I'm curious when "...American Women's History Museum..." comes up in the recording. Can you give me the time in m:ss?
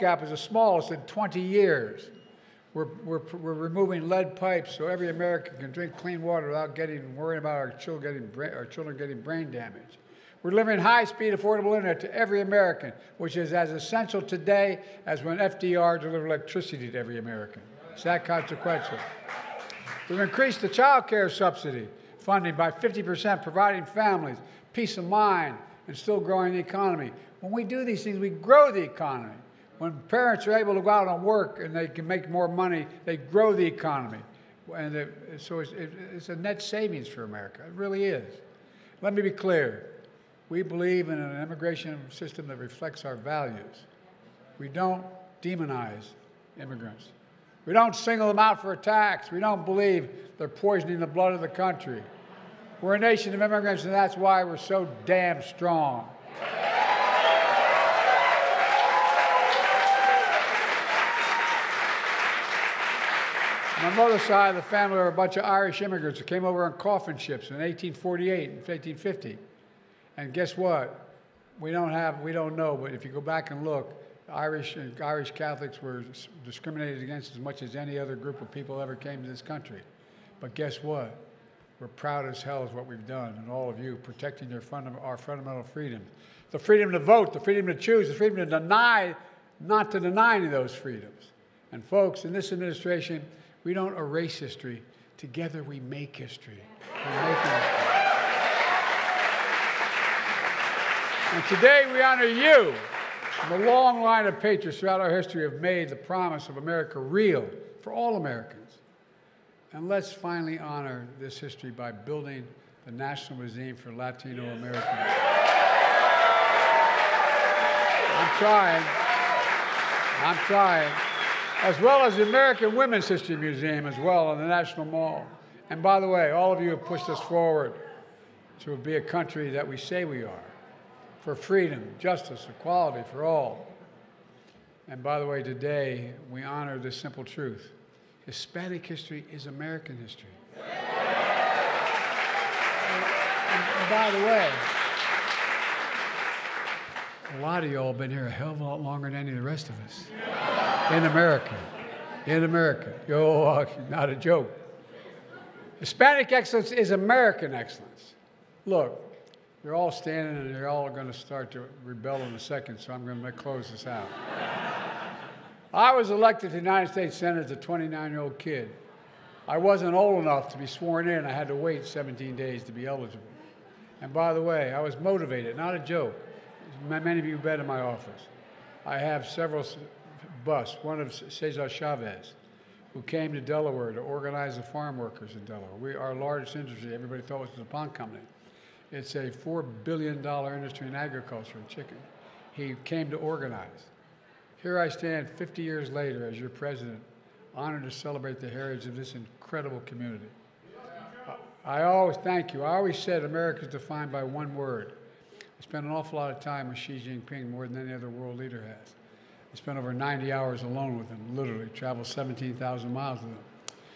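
2:02.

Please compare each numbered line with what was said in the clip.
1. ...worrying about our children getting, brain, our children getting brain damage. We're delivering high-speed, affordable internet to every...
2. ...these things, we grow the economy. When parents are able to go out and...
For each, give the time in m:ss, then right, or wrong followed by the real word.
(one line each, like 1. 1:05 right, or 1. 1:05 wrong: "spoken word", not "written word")
1. 0:07 right
2. 0:27 right.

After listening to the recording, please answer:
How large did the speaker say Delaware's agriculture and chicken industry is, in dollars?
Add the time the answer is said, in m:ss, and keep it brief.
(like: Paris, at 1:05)
$4 billion, at 3:09.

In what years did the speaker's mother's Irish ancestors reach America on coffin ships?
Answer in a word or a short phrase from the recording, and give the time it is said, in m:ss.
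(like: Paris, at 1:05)
1848 and 1850, at 1:07.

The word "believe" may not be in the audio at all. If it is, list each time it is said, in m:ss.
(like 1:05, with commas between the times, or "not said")
0:40, 0:49.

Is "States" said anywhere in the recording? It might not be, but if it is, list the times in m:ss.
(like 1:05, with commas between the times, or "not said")
2:46.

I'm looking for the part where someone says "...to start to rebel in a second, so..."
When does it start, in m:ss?
2:41.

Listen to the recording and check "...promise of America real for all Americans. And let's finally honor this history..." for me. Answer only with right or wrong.
right.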